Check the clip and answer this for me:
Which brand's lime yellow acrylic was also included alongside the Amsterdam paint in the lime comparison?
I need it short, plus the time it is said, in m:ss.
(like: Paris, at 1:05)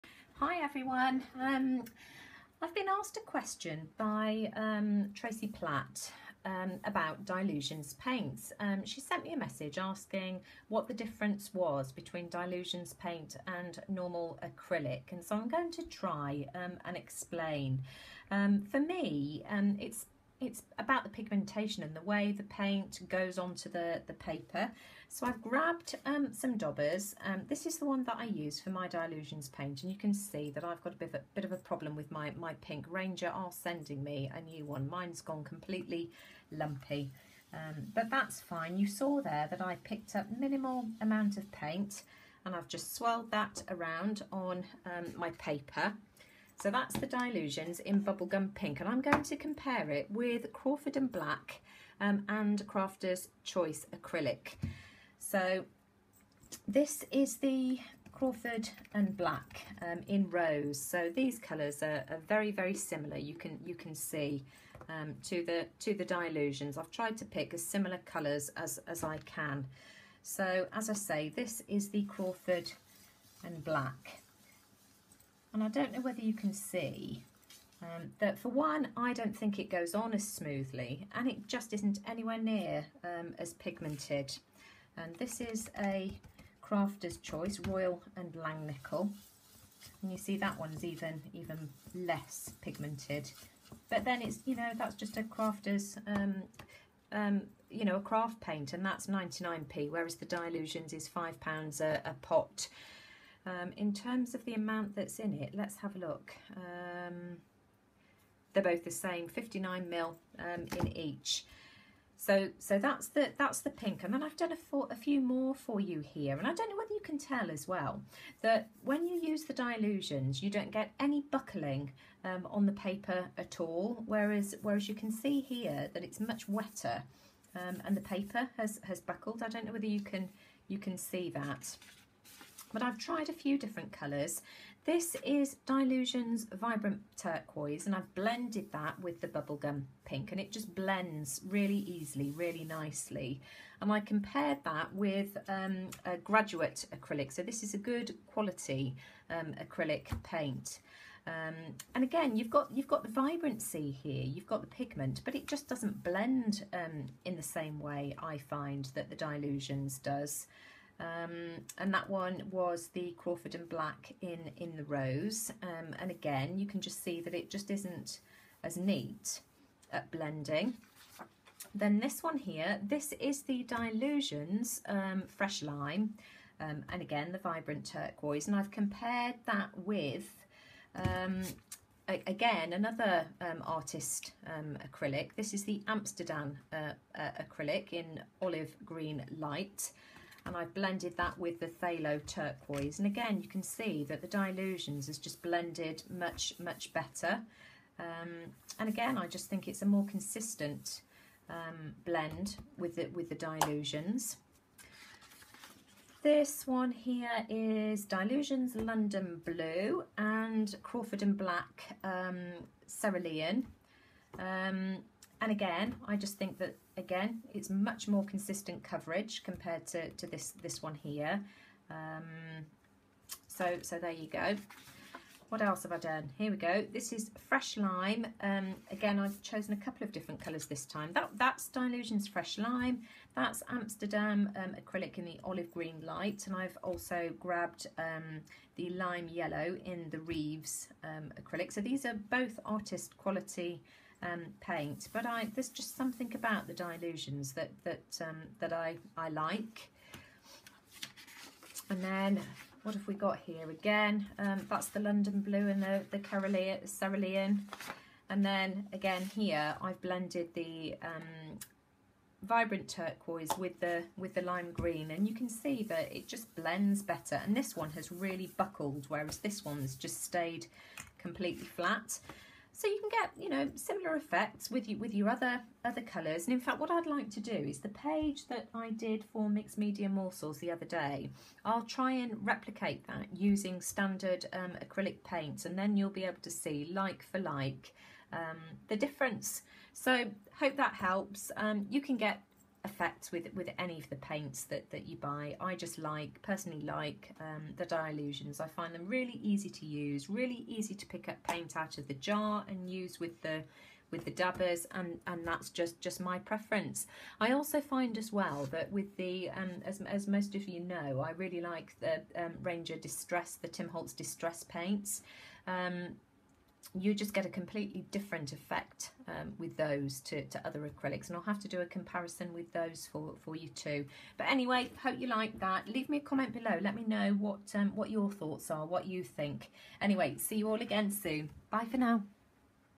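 Reeves, at 4:00.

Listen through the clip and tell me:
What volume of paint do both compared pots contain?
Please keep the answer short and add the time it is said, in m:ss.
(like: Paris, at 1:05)
59 ml, at 1:49.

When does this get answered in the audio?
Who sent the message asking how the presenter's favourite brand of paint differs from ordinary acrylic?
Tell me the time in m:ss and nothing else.
0:05.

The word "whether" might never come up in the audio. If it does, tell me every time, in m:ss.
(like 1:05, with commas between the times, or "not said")
1:16, 1:56, 2:09.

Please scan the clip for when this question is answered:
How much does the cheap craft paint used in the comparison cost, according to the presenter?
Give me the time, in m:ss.
1:39.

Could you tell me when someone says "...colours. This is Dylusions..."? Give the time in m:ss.
2:13.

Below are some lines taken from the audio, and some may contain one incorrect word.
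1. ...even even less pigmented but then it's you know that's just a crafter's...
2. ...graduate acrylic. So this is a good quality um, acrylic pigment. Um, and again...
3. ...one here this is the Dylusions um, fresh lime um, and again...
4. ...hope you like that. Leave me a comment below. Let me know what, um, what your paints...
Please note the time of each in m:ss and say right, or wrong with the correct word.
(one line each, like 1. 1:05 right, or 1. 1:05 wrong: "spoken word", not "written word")
1. 1:30 right
2. 2:26 wrong: "paint", not "pigment"
3. 2:52 right
4. 5:25 wrong: "thoughts", not "paints".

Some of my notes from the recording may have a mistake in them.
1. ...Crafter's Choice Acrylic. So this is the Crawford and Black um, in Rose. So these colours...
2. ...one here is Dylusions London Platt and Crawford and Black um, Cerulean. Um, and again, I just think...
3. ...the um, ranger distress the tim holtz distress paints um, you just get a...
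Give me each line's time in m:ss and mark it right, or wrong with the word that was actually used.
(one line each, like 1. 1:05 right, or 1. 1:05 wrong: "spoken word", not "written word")
1. 0:52 right
2. 3:26 wrong: "Blue", not "Platt"
3. 5:11 right.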